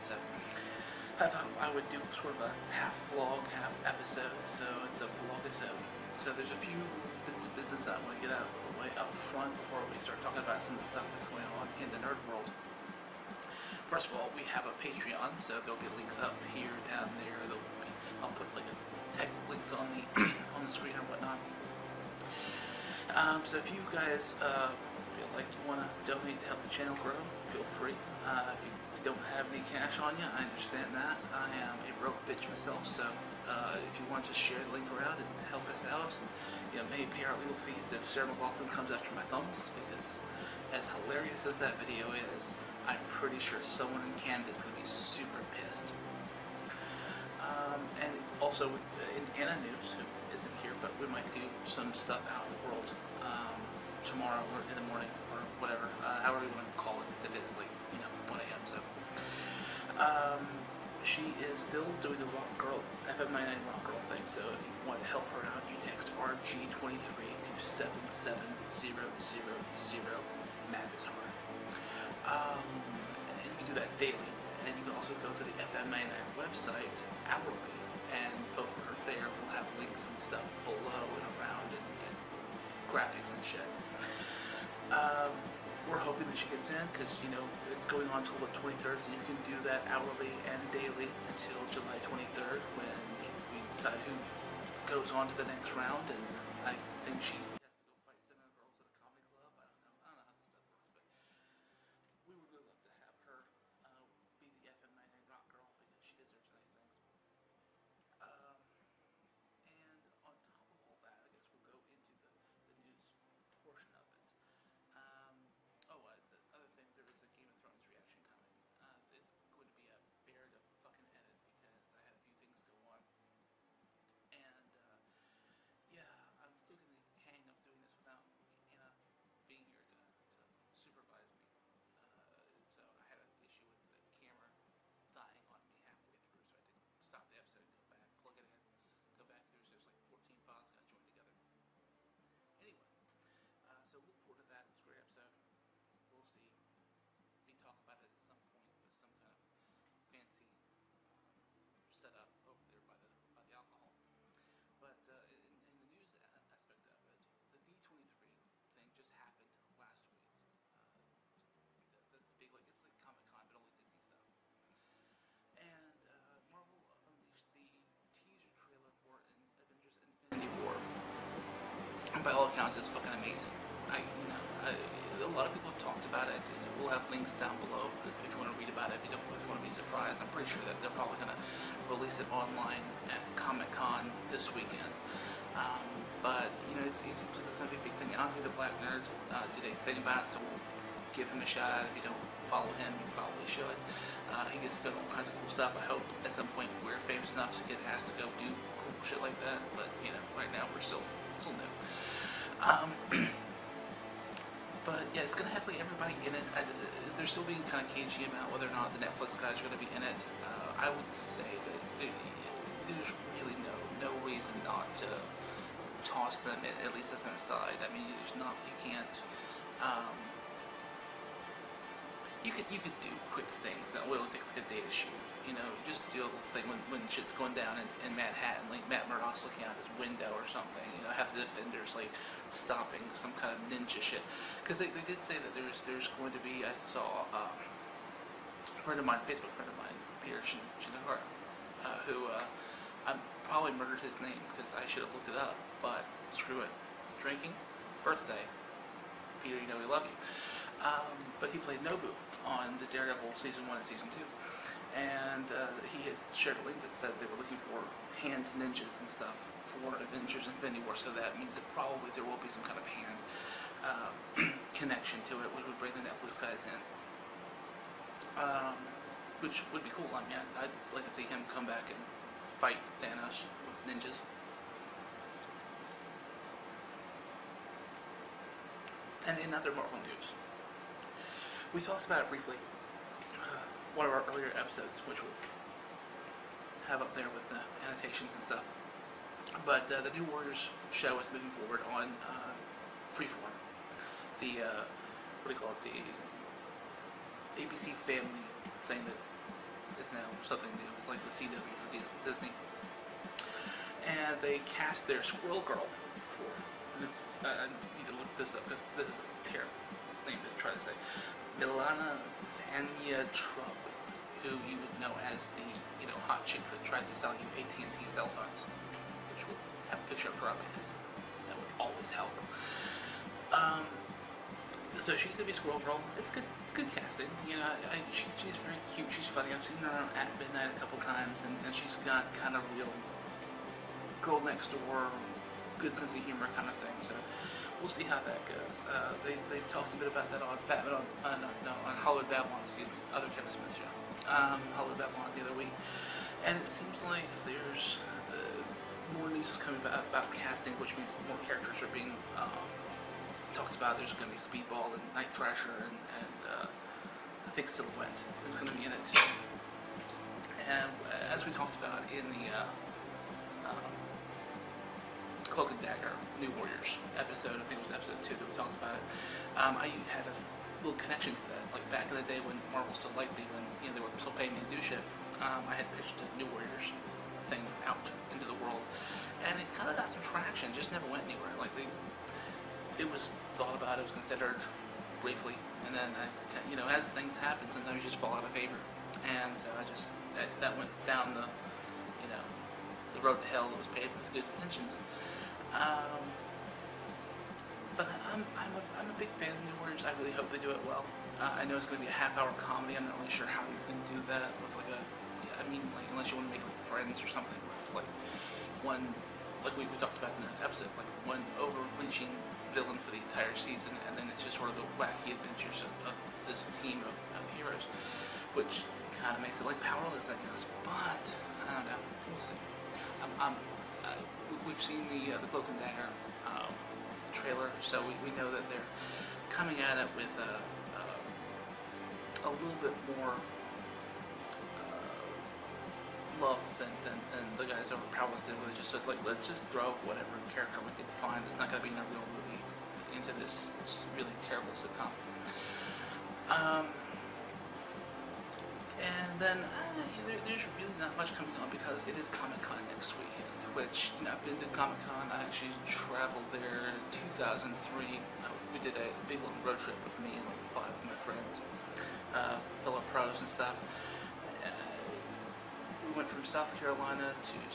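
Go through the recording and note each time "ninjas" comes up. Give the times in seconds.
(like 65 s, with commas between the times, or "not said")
233 s, 258 s, 273 s.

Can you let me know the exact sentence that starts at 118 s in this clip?
Uh, it's going to be a bear to fucking edit because I had a few things go on.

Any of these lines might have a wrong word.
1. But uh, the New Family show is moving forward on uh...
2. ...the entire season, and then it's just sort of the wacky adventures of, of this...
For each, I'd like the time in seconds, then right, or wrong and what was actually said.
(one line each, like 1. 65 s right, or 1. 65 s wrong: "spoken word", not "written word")
1. 289 s wrong: "Warriors", not "Family"
2. 413 s right.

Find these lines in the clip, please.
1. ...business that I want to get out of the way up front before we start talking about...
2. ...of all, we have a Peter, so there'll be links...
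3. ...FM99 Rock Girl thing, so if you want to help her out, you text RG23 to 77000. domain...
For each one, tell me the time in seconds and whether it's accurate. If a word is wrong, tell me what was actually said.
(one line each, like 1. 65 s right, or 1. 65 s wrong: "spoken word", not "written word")
1. 7 s right
2. 14 s wrong: "Patreon", not "Peter"
3. 63 s right.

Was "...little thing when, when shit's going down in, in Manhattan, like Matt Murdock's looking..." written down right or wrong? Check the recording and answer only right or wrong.
right.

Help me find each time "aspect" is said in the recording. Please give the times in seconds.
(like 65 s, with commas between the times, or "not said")
156 s.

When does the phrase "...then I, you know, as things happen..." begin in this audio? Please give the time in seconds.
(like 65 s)
385 s.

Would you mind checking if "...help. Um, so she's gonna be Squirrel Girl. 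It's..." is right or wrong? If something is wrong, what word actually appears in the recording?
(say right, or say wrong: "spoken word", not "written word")
right.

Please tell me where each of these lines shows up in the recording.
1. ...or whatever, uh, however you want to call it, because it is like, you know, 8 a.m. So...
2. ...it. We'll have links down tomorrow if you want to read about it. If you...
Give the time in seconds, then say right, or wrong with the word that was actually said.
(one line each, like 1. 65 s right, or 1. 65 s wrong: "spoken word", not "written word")
1. 55 s wrong: "1", not "8"
2. 176 s wrong: "below", not "tomorrow".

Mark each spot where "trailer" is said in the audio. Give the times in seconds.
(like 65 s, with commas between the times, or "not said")
168 s, 427 s.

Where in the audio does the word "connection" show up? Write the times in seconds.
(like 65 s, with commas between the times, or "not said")
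264 s, 371 s.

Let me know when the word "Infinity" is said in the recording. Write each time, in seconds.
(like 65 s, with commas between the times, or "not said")
170 s, 260 s.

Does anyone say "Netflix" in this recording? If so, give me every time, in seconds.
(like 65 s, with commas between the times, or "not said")
209 s, 266 s.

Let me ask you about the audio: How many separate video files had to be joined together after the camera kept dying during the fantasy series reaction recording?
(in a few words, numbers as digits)
14.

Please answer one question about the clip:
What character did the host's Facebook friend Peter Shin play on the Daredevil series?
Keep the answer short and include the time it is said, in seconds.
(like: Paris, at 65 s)
Nobu, at 251 s.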